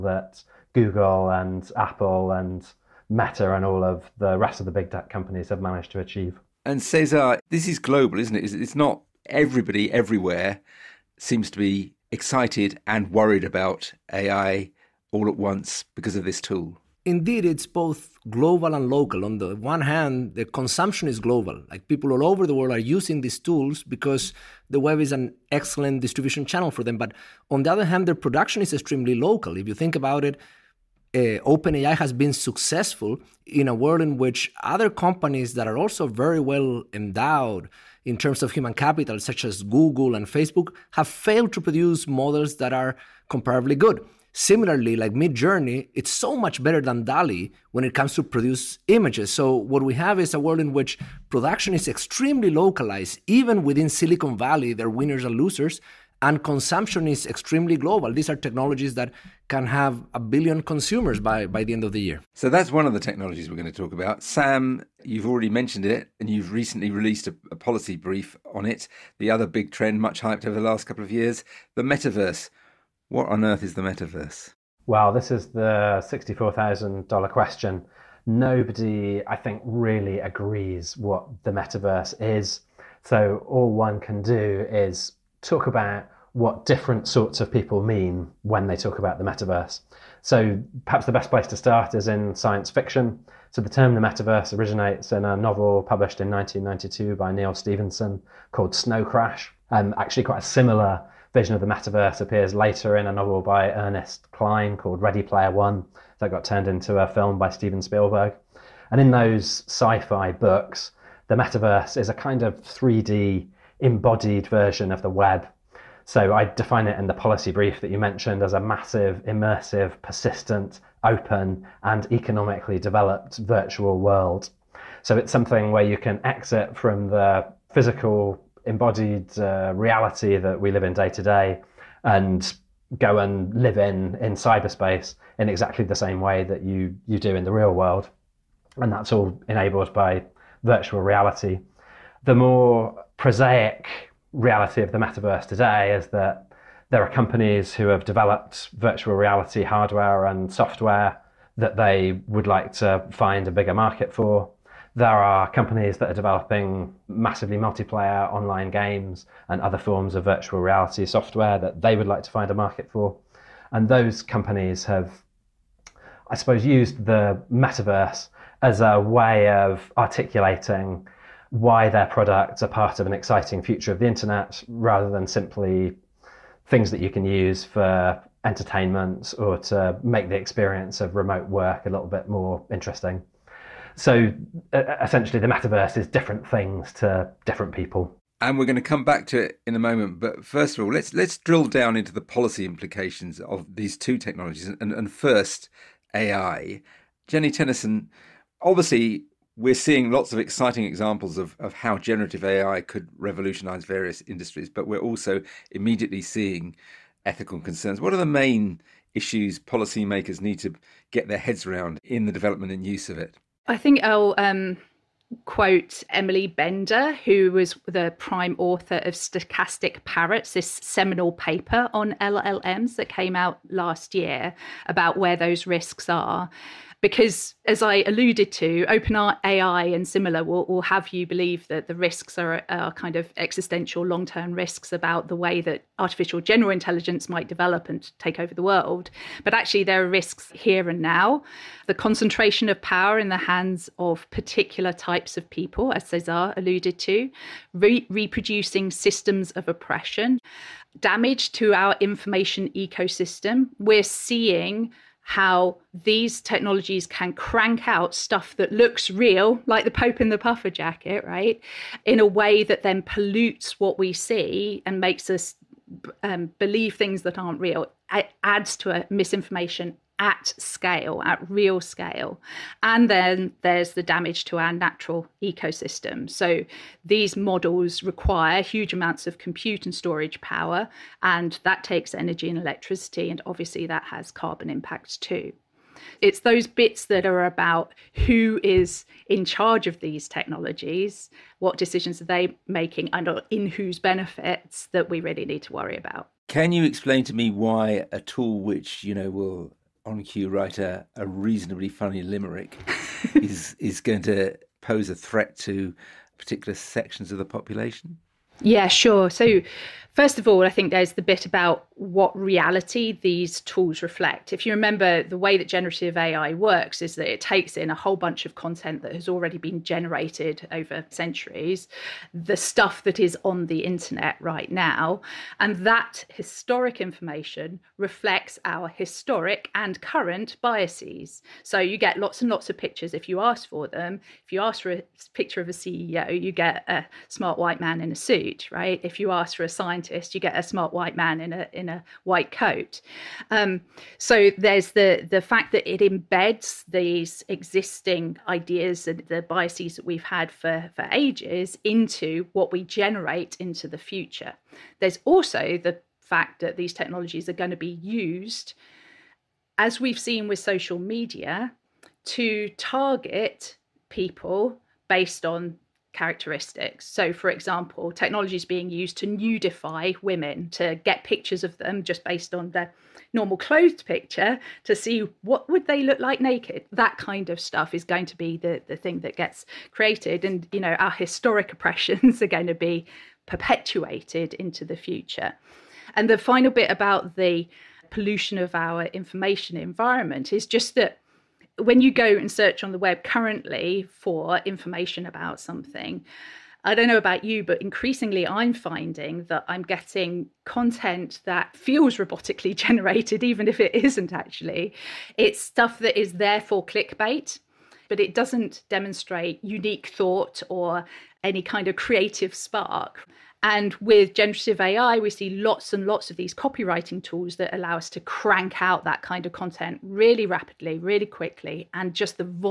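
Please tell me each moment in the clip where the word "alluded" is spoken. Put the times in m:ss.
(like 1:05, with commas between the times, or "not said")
3:48, 4:06.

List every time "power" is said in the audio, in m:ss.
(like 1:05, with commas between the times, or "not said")
4:02, 4:40.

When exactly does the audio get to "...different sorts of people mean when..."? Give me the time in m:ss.
1:26.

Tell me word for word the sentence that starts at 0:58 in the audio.
These are technologies that can have a billion consumers by, by the end of the year.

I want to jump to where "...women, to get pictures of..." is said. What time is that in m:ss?
6:10.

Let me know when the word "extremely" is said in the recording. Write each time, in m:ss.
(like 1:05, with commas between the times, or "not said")
0:28, 0:51, 0:57.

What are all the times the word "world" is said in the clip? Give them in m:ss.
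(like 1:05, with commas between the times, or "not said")
0:22, 0:33, 0:50, 2:03, 2:17, 3:58.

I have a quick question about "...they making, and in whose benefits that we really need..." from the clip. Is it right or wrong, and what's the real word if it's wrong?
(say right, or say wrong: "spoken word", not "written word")
right.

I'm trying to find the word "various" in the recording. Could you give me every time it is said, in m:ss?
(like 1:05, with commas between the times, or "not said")
3:23.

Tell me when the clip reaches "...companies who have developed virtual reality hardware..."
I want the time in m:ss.
2:27.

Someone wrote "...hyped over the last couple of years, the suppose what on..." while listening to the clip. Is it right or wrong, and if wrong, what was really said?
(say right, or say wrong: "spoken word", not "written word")
wrong: "metaverse", not "suppose".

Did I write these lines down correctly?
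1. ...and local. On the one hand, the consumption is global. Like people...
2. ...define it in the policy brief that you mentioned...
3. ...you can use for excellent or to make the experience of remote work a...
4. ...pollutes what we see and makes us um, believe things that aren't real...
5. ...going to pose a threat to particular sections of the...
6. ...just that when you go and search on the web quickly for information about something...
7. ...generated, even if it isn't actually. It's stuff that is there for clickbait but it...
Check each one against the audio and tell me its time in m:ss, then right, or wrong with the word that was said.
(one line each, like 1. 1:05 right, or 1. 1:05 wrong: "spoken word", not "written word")
1. 0:18 right
2. 1:56 right
3. 2:56 wrong: "entertainment", not "excellent"
4. 4:23 right
5. 5:03 right
6. 6:30 wrong: "currently", not "quickly"
7. 6:42 right.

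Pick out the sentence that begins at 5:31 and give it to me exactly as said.
So you get lots and lots of pictures if you ask for them.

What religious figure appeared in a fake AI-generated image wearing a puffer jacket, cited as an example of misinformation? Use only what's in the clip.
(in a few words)
the Pope.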